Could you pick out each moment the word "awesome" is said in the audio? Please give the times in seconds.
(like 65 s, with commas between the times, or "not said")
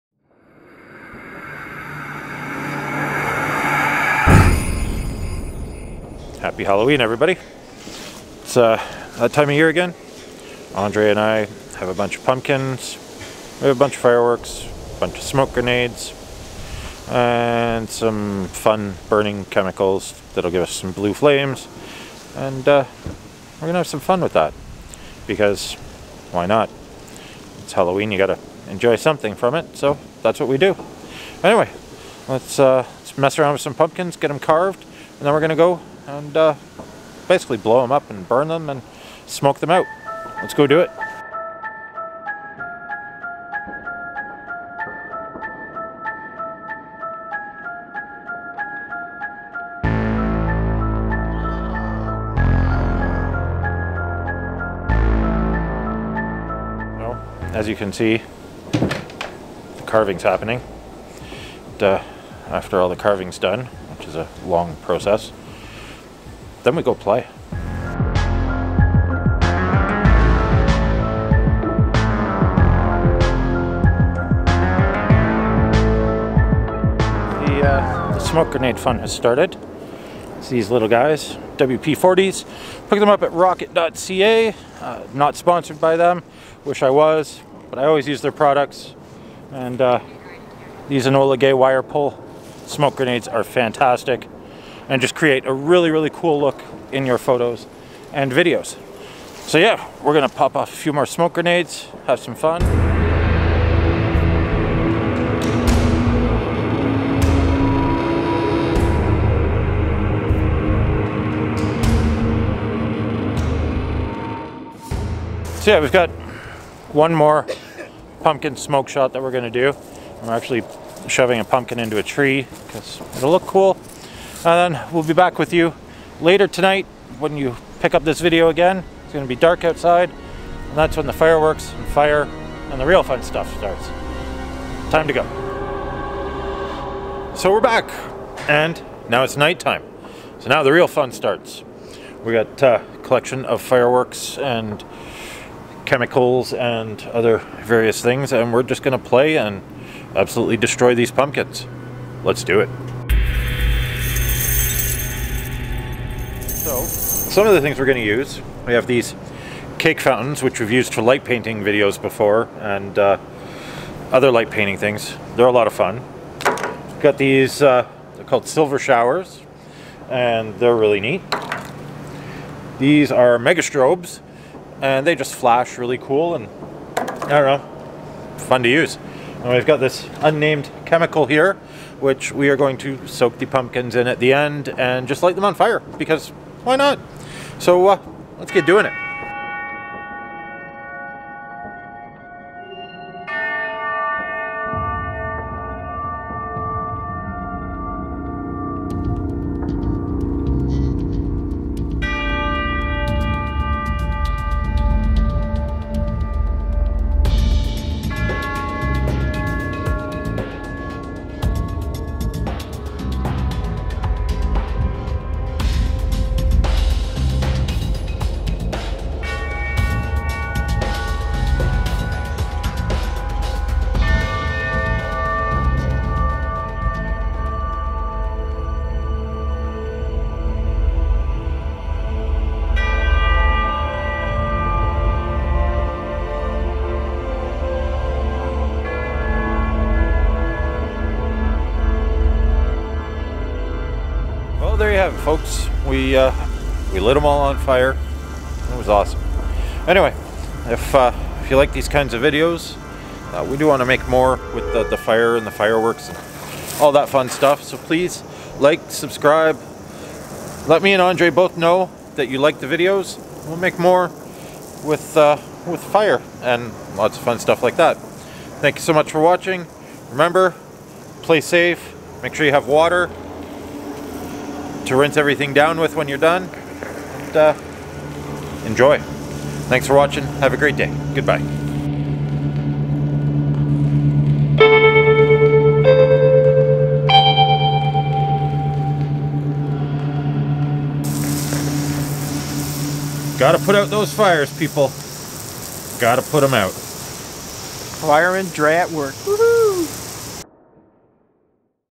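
248 s.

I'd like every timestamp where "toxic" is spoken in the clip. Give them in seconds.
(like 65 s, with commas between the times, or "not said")
not said.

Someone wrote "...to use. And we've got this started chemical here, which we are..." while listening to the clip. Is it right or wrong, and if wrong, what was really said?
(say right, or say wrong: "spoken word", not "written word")
wrong: "unnamed", not "started".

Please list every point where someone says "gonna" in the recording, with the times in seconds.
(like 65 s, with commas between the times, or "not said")
23 s, 35 s, 100 s, 119 s.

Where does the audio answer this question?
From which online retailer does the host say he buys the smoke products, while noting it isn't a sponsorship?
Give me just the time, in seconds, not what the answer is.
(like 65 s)
83 s.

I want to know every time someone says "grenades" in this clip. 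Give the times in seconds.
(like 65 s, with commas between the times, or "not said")
15 s, 78 s, 92 s, 101 s.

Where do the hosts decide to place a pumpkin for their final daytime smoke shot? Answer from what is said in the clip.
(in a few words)
into a tree.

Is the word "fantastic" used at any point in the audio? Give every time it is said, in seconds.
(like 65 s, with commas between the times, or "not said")
93 s.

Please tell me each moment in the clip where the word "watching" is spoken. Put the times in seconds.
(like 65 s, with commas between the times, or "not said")
269 s, 279 s.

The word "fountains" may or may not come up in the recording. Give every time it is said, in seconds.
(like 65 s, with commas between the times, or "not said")
160 s.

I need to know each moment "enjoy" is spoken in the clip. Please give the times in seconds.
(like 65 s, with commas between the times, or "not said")
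28 s, 278 s.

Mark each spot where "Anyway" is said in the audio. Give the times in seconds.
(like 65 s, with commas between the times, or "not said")
31 s, 249 s.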